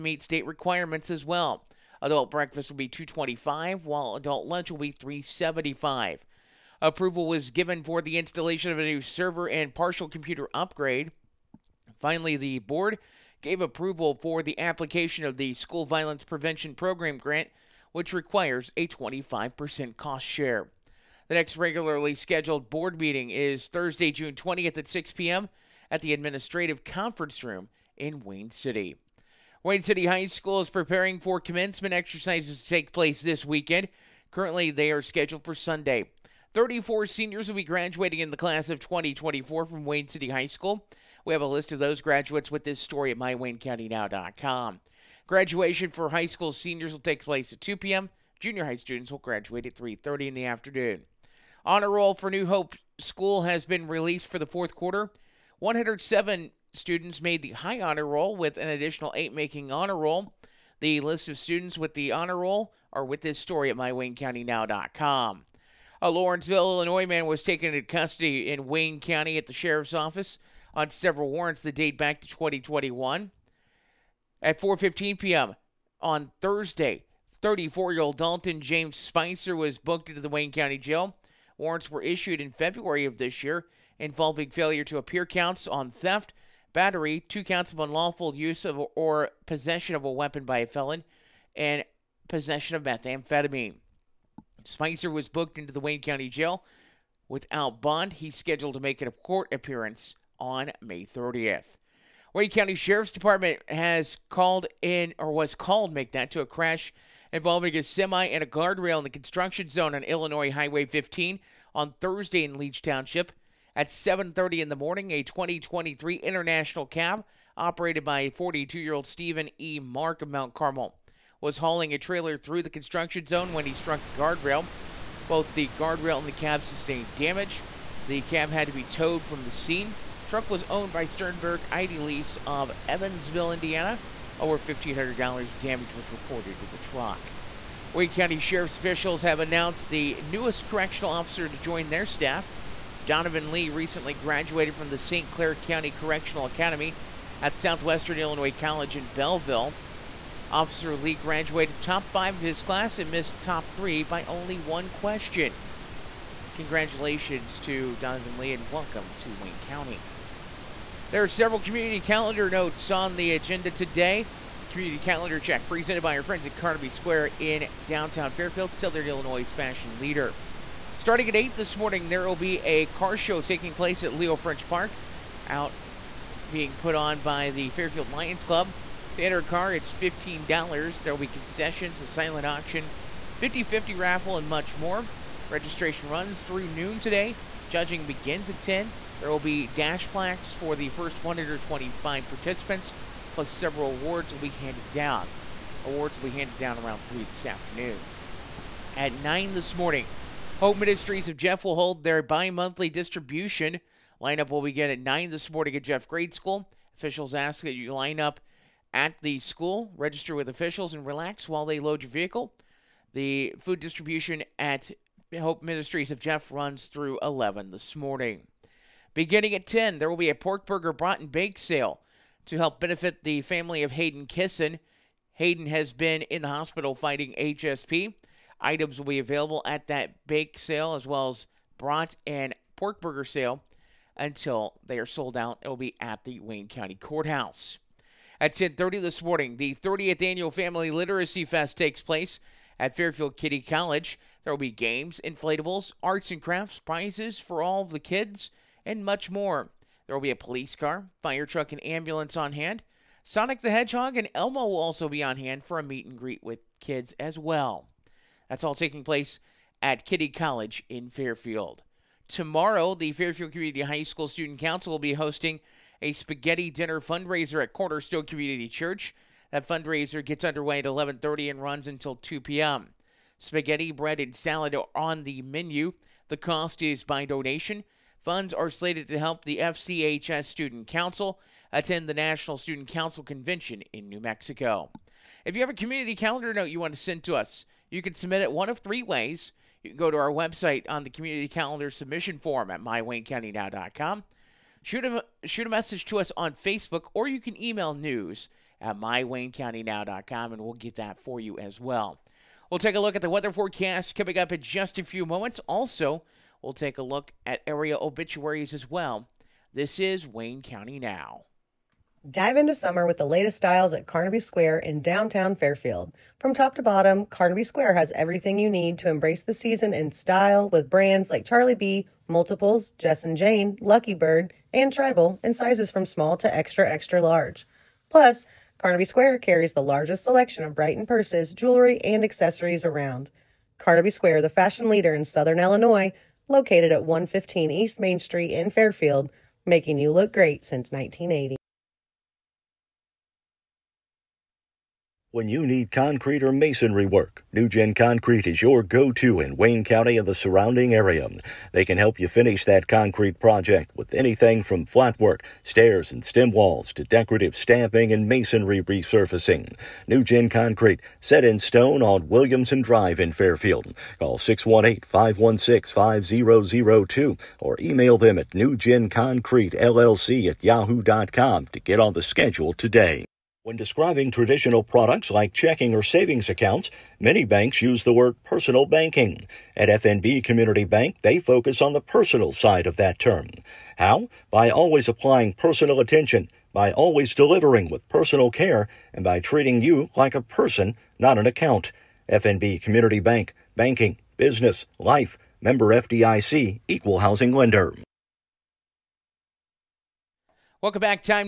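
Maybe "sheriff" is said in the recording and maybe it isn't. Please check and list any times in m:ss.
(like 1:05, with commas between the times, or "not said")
1:09, 1:42, 2:18.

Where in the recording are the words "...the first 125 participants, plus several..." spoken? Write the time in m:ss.
3:10.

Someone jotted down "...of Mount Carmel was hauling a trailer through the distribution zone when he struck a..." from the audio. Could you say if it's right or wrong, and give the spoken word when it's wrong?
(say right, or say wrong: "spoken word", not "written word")
wrong: "construction", not "distribution".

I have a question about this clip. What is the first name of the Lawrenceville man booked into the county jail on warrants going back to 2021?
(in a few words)
Dalton.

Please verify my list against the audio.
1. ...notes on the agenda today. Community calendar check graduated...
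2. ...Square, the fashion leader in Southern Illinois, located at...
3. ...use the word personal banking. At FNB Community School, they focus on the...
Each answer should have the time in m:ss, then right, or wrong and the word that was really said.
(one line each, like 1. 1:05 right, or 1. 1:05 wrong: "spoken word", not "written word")
1. 2:42 wrong: "presented", not "graduated"
2. 5:34 right
3. 6:17 wrong: "Bank", not "School".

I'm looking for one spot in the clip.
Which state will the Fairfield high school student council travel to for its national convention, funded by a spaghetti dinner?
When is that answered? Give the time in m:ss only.
4:44.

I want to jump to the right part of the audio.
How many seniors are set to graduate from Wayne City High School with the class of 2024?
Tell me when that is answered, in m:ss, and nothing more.
0:36.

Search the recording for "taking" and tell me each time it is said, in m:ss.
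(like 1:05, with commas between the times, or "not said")
2:53, 4:18.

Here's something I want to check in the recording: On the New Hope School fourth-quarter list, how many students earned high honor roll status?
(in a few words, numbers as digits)
107.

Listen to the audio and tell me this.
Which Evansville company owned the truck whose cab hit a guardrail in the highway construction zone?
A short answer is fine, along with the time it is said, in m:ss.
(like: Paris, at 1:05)
Sternberg Idealease, at 2:11.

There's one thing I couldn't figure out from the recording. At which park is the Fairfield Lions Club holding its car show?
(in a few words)
Leo French Park.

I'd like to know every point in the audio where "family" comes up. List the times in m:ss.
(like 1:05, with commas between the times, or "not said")
3:43, 4:00.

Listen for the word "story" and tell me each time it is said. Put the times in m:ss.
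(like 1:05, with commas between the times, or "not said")
0:42, 1:03.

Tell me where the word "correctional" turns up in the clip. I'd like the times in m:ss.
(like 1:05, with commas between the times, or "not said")
2:20, 2:25.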